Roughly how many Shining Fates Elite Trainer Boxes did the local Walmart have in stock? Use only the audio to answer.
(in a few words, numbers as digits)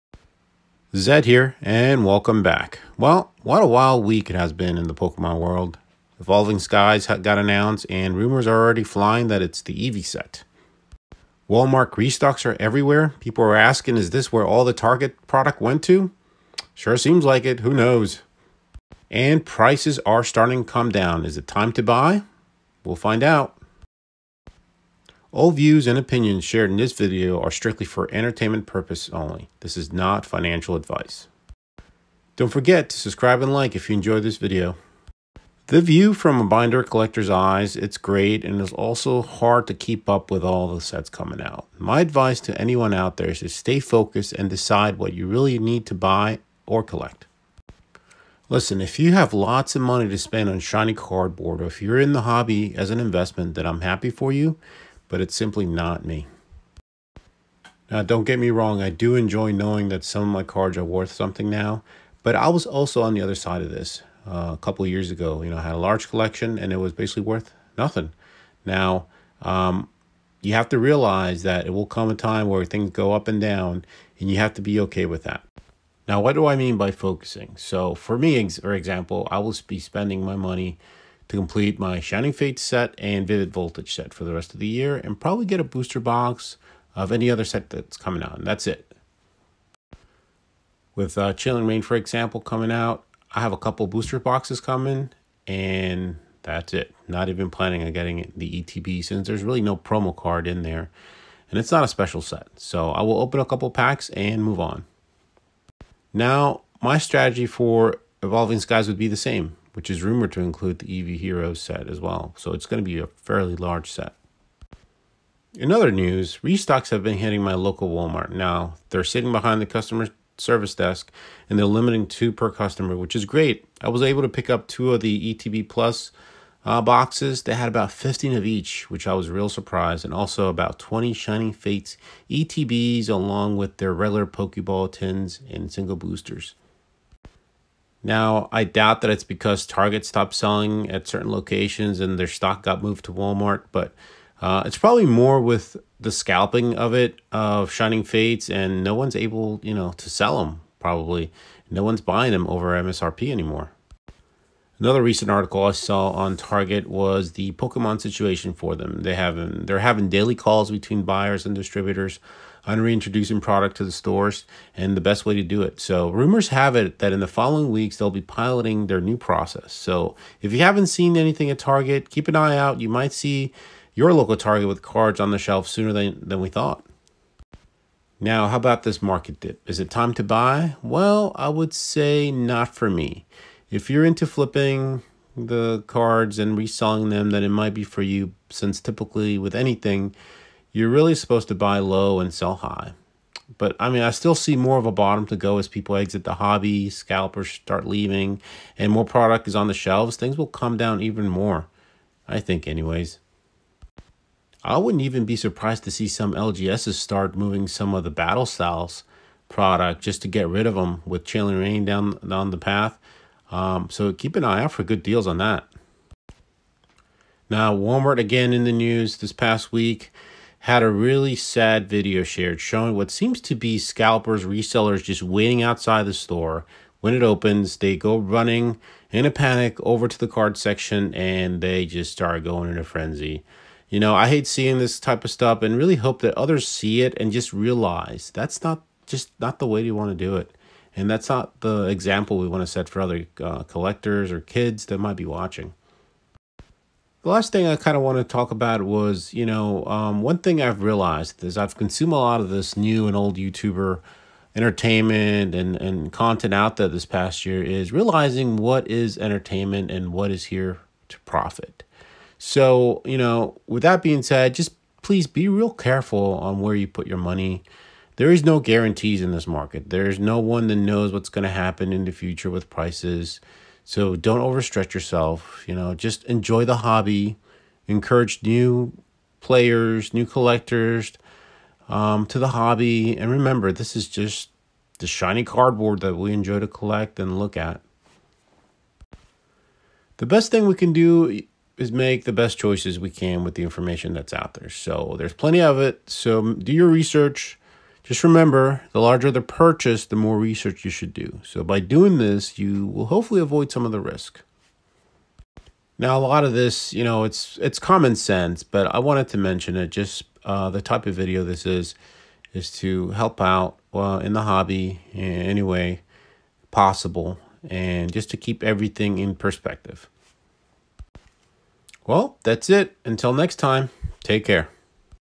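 20.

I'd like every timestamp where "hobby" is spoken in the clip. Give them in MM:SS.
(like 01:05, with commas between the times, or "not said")
00:52, 03:16, 04:36, 04:42, 05:14.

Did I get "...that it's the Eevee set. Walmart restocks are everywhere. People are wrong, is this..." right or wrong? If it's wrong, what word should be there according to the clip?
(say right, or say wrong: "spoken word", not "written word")
wrong: "asking", not "wrong".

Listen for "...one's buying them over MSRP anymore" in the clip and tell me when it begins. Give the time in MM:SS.
02:31.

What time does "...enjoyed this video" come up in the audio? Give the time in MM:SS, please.
00:33.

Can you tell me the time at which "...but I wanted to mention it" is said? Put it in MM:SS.
05:08.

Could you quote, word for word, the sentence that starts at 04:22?
So, you know, with that being said, just please be real careful on where you put your money.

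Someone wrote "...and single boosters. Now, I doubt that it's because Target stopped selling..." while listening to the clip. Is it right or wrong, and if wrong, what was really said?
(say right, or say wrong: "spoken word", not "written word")
right.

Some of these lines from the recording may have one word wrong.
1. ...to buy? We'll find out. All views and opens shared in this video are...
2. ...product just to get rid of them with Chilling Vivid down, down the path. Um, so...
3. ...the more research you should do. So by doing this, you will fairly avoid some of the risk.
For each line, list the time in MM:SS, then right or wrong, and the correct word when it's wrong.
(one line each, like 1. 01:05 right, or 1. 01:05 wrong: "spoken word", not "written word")
1. 00:21 wrong: "opinions", not "opens"
2. 03:29 wrong: "Reign", not "Vivid"
3. 05:00 wrong: "hopefully", not "fairly".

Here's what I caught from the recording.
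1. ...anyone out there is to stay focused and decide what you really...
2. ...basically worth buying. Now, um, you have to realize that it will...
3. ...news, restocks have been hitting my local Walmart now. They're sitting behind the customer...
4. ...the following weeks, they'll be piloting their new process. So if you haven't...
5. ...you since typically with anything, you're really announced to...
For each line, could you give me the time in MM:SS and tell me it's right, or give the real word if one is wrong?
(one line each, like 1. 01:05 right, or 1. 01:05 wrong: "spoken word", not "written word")
1. 00:42 right
2. 01:06 wrong: "nothing", not "buying"
3. 01:55 right
4. 02:47 right
5. 03:08 wrong: "supposed", not "announced".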